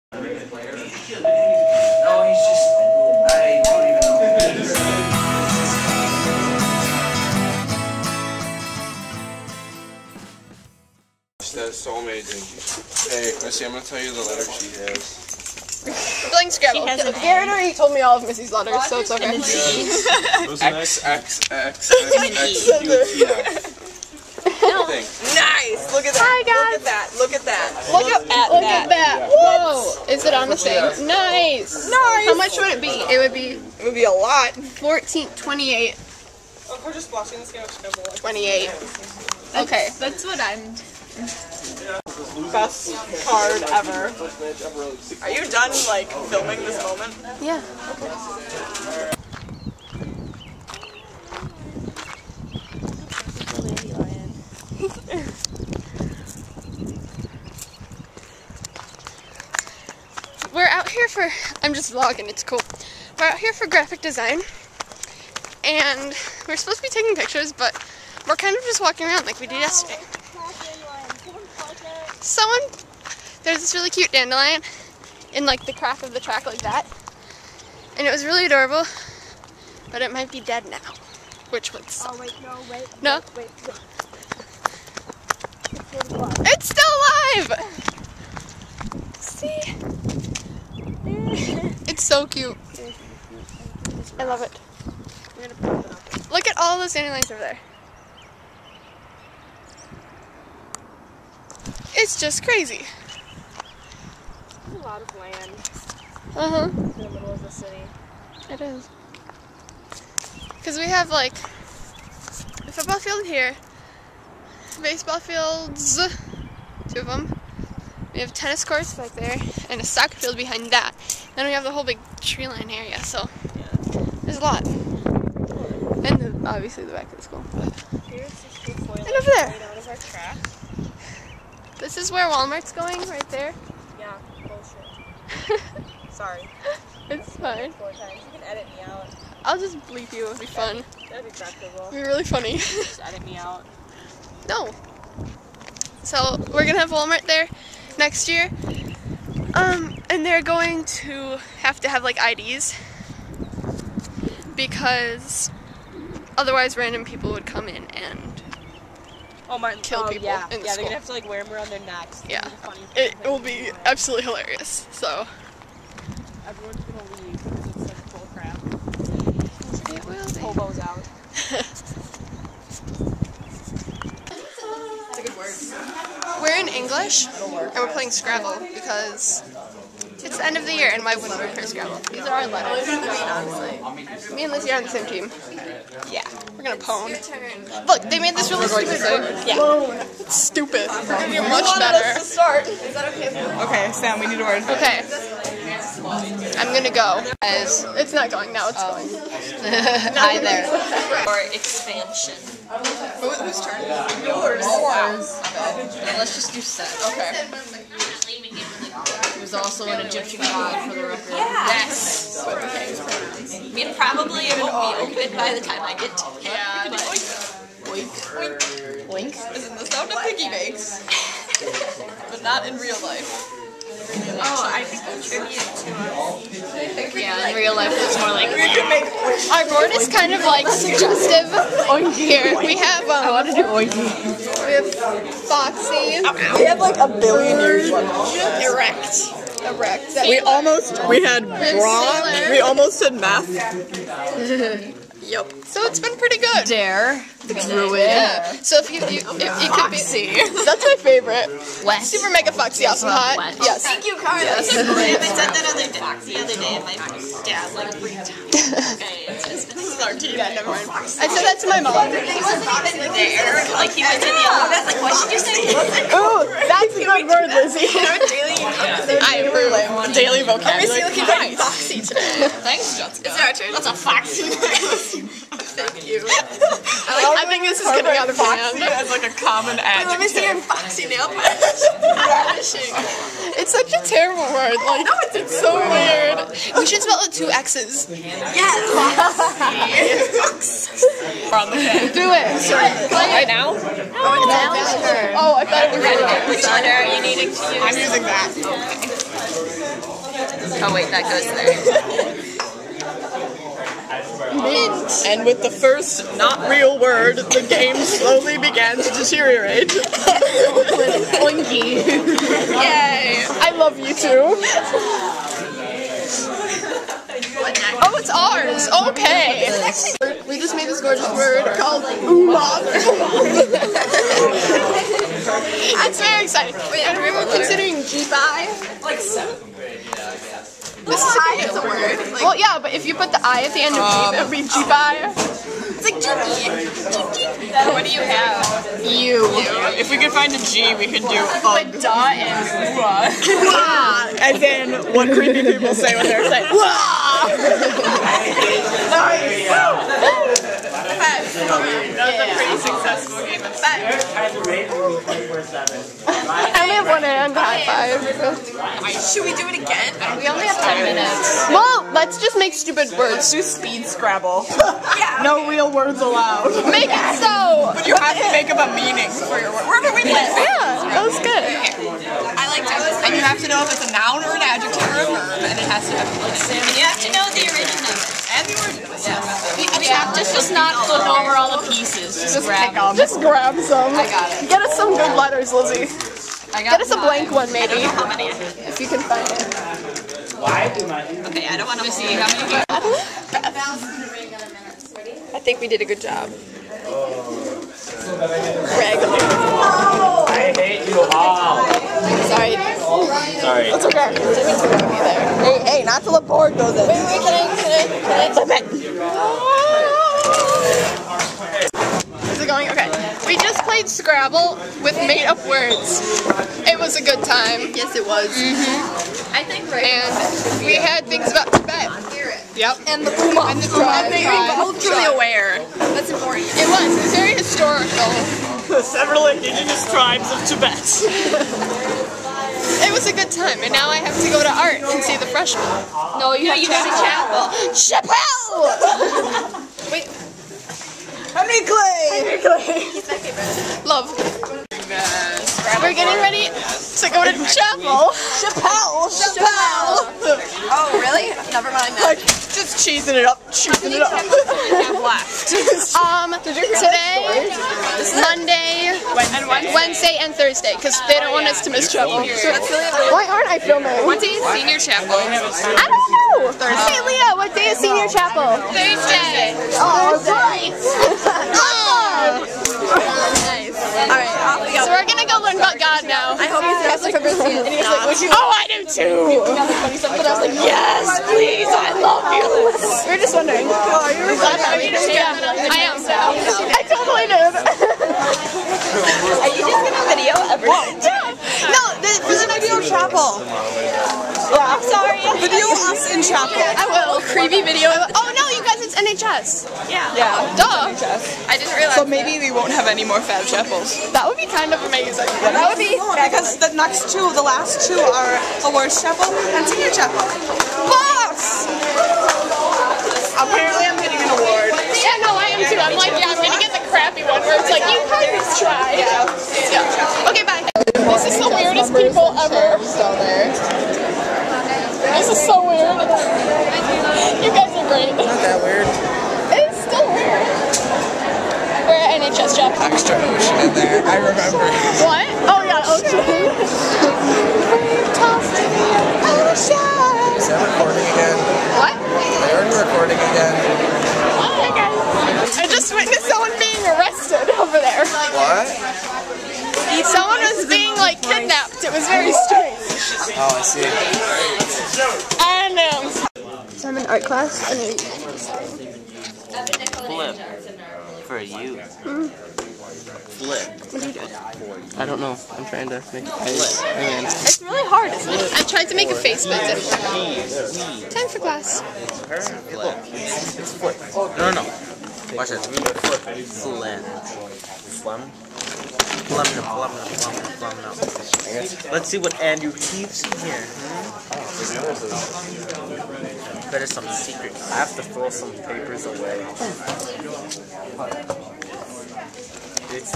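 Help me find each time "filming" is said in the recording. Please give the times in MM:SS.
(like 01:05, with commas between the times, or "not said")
00:46, 07:43.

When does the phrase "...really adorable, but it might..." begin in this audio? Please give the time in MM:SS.
01:18.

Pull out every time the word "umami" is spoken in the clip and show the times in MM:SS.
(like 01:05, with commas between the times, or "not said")
05:22.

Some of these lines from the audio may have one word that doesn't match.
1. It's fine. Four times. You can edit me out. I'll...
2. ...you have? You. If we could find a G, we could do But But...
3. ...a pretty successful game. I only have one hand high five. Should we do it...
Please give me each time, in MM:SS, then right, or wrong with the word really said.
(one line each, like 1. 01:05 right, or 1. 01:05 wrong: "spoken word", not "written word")
1. 02:17 right
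2. 05:38 wrong: "Put", not "But"
3. 05:52 right.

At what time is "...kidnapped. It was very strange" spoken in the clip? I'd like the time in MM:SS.
09:11.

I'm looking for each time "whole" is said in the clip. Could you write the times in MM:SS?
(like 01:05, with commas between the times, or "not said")
02:01.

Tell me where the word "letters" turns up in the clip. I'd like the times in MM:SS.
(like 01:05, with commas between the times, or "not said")
03:02, 04:56, 06:25.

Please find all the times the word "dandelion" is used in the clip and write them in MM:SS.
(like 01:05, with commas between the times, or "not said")
01:14, 01:36.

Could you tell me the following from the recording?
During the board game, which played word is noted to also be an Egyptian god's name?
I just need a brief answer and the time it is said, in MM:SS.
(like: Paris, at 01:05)
Set, at 03:26.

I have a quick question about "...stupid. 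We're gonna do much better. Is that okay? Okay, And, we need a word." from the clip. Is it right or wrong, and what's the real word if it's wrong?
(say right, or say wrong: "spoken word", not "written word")
wrong: "Sam", not "And".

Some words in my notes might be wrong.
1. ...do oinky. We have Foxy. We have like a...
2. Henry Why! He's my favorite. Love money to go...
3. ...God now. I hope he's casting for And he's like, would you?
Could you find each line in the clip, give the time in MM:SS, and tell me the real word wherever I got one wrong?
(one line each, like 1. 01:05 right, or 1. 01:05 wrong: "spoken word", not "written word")
1. 03:53 right
2. 07:22 wrong: "Clay", not "Why"
3. 07:55 right.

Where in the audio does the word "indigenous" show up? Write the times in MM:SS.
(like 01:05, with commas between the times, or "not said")
07:09.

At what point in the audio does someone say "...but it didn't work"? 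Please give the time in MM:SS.
09:29.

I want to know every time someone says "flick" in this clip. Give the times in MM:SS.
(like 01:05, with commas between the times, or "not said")
not said.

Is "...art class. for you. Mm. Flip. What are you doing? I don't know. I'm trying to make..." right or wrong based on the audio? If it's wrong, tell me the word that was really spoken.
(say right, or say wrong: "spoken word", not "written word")
right.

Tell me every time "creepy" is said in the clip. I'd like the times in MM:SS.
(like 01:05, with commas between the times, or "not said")
05:45, 08:17.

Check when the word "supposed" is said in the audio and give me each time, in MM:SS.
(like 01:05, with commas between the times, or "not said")
01:06.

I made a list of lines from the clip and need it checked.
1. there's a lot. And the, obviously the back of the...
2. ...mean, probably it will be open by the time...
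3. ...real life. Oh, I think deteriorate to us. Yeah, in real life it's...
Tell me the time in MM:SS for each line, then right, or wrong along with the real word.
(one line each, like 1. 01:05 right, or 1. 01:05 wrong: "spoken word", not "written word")
1. 02:04 right
2. 03:33 right
3. 03:42 wrong: "contribute", not "deteriorate".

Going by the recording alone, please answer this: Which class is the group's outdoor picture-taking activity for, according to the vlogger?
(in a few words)
Graphic design.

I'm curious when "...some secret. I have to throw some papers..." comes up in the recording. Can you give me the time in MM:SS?
09:47.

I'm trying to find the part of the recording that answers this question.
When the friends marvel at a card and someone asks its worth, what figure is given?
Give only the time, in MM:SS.
00:34.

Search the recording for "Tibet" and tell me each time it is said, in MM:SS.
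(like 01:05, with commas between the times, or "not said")
07:01, 07:10.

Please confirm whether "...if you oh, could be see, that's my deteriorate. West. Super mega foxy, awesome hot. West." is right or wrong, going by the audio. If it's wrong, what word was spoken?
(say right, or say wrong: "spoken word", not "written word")
wrong: "favorite", not "deteriorate".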